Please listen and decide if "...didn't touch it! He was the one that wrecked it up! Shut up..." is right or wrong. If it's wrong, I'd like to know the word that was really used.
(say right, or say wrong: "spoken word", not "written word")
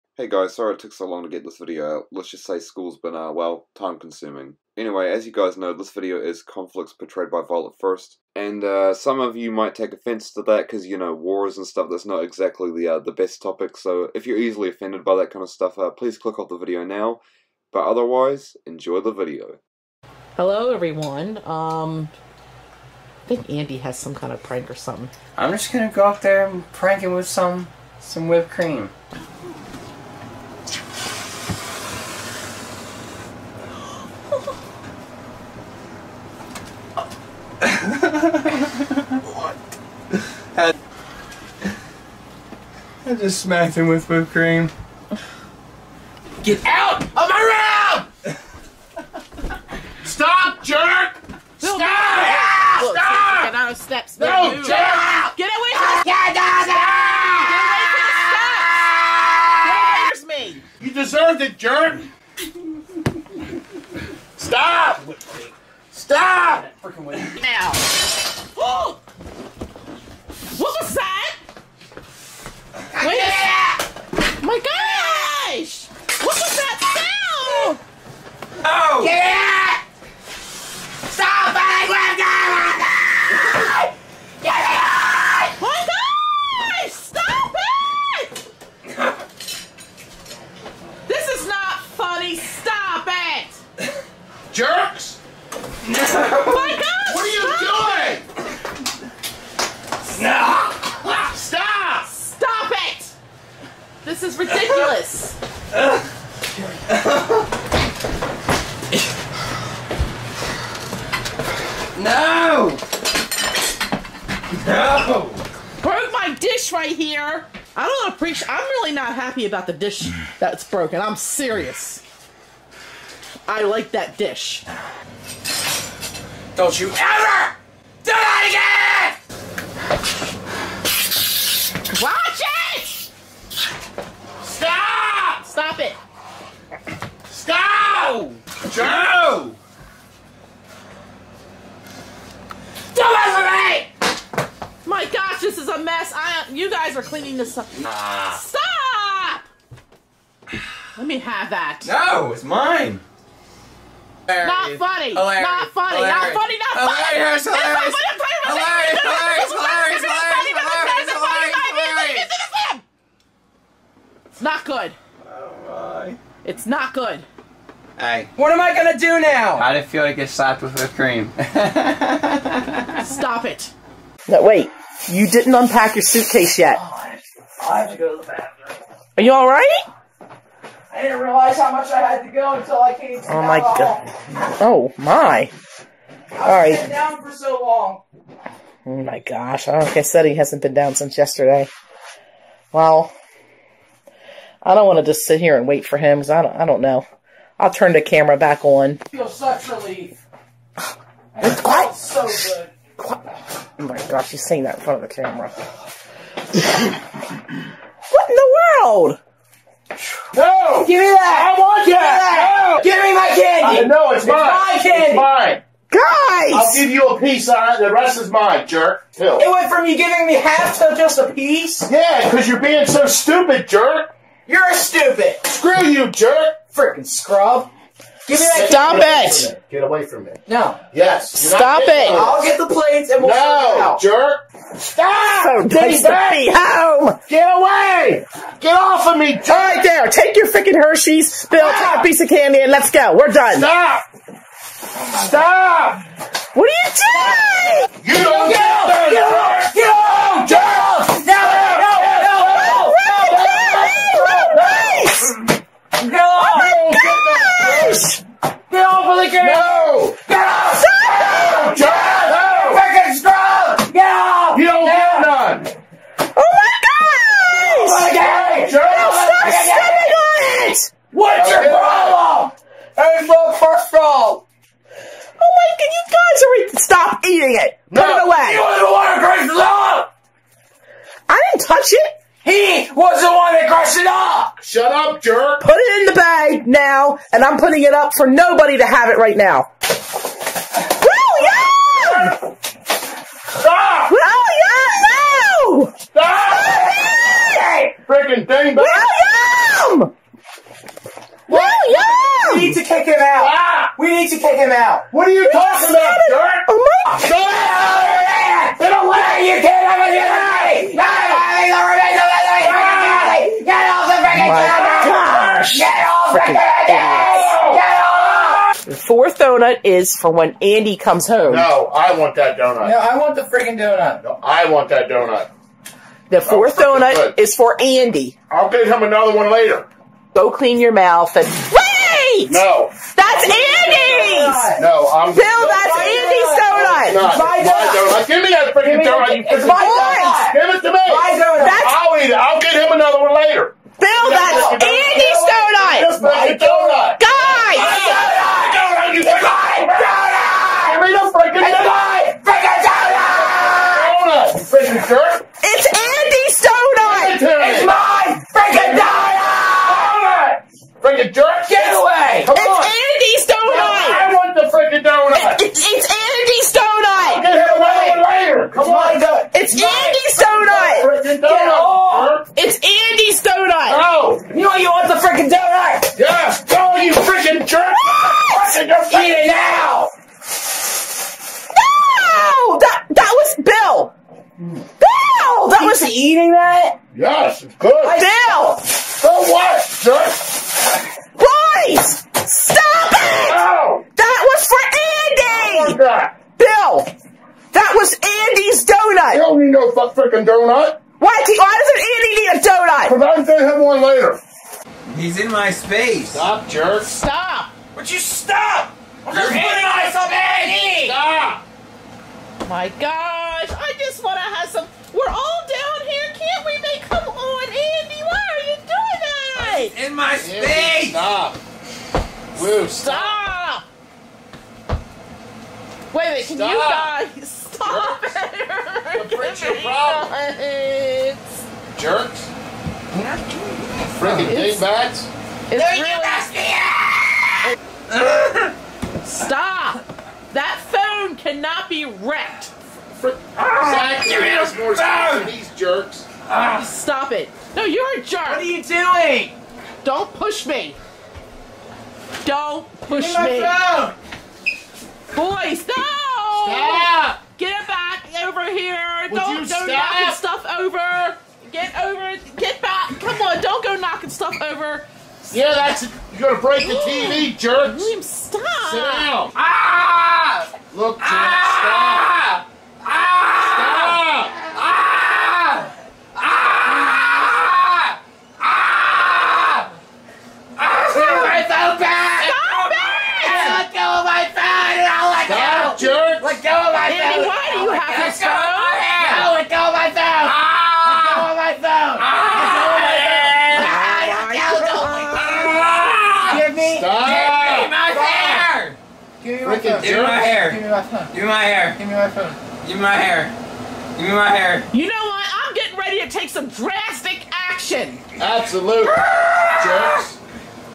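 wrong: "crushed", not "wrecked".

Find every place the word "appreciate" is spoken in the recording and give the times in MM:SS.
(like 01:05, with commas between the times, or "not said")
01:58.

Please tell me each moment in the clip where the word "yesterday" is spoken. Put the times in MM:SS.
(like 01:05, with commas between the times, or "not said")
03:11.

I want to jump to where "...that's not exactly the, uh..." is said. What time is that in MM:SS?
00:11.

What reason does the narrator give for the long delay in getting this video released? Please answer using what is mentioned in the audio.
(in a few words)
School.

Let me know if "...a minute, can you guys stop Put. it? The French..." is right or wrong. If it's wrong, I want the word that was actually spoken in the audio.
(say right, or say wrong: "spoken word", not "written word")
wrong: "Jerks", not "Put".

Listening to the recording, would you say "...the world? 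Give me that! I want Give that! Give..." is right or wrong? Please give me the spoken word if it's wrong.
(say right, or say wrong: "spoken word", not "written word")
right.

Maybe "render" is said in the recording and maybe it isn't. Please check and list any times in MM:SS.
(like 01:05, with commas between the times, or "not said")
not said.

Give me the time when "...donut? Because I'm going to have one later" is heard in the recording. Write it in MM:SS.
06:42.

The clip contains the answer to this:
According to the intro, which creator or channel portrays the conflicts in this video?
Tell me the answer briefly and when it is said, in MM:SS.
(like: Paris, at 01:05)
Violette1st, at 00:07.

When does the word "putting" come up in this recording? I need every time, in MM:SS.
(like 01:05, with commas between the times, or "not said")
04:47, 06:49.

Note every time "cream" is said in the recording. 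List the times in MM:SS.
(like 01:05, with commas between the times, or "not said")
00:28, 00:44, 02:50.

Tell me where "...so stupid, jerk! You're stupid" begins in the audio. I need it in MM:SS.
03:42.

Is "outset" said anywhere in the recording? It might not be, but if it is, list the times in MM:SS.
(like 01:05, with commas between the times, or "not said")
not said.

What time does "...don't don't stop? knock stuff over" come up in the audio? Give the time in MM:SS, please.
07:39.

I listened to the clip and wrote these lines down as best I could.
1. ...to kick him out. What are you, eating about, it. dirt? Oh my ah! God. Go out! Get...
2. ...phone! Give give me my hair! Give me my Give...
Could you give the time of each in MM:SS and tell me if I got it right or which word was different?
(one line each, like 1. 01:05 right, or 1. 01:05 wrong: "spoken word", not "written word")
1. 05:04 wrong: "talking", not "eating"
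2. 08:18 right.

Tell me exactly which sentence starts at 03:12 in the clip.
Well, I don't want to just sit here and wait for him because I don't.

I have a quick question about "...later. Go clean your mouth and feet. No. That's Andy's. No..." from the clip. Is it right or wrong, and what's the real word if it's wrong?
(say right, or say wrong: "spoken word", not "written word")
right.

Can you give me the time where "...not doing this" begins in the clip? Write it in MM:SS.
07:13.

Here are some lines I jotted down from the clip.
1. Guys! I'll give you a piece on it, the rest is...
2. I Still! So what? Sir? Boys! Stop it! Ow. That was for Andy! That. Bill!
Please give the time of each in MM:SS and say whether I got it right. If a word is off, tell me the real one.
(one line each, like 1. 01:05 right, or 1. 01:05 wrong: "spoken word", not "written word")
1. 03:35 right
2. 06:27 right.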